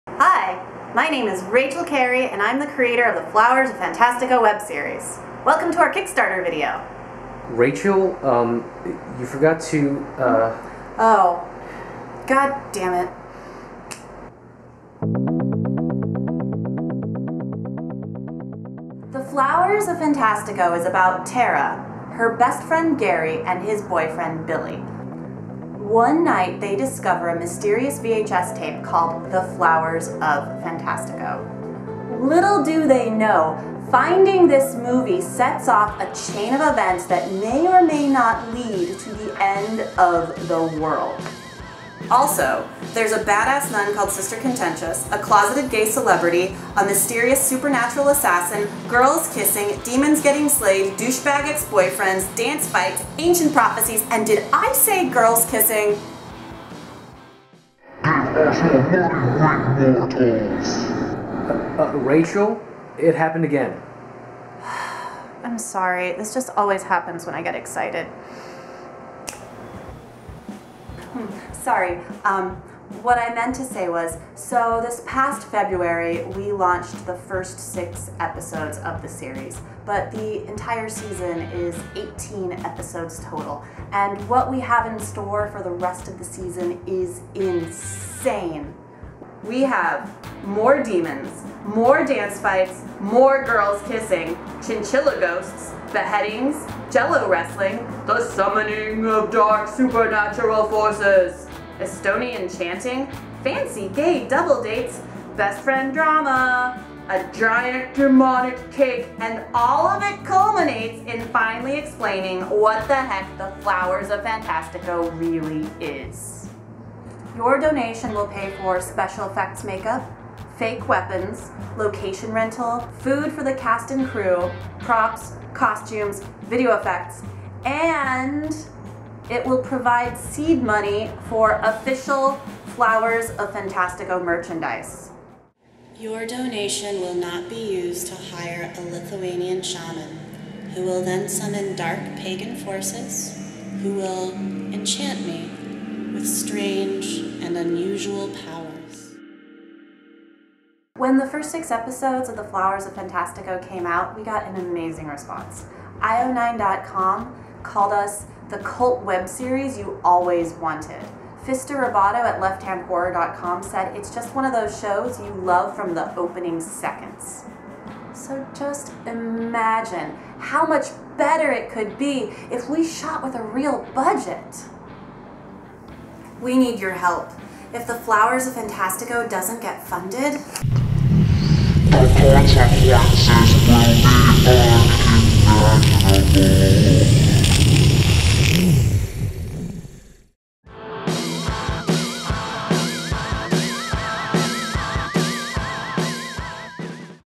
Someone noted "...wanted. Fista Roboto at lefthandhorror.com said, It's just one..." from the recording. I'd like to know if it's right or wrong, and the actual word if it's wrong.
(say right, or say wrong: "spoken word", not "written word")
right.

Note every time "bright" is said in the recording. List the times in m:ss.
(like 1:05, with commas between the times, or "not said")
not said.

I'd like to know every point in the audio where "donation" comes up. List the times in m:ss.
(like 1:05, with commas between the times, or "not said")
1:57, 2:16.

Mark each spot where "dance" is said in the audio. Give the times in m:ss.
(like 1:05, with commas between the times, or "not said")
0:52, 1:32.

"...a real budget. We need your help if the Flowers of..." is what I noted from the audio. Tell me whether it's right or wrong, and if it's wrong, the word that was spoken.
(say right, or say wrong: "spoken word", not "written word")
right.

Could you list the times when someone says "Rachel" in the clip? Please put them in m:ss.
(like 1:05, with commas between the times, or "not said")
0:01, 0:07, 1:01.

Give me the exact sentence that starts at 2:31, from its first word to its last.
When the first six episodes of The Flowers of Fantastico came out, we got an amazing response.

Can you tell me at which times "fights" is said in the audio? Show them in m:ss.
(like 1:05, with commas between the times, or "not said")
0:52, 1:32.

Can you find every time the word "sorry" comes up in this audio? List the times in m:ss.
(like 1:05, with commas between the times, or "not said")
1:05, 1:11.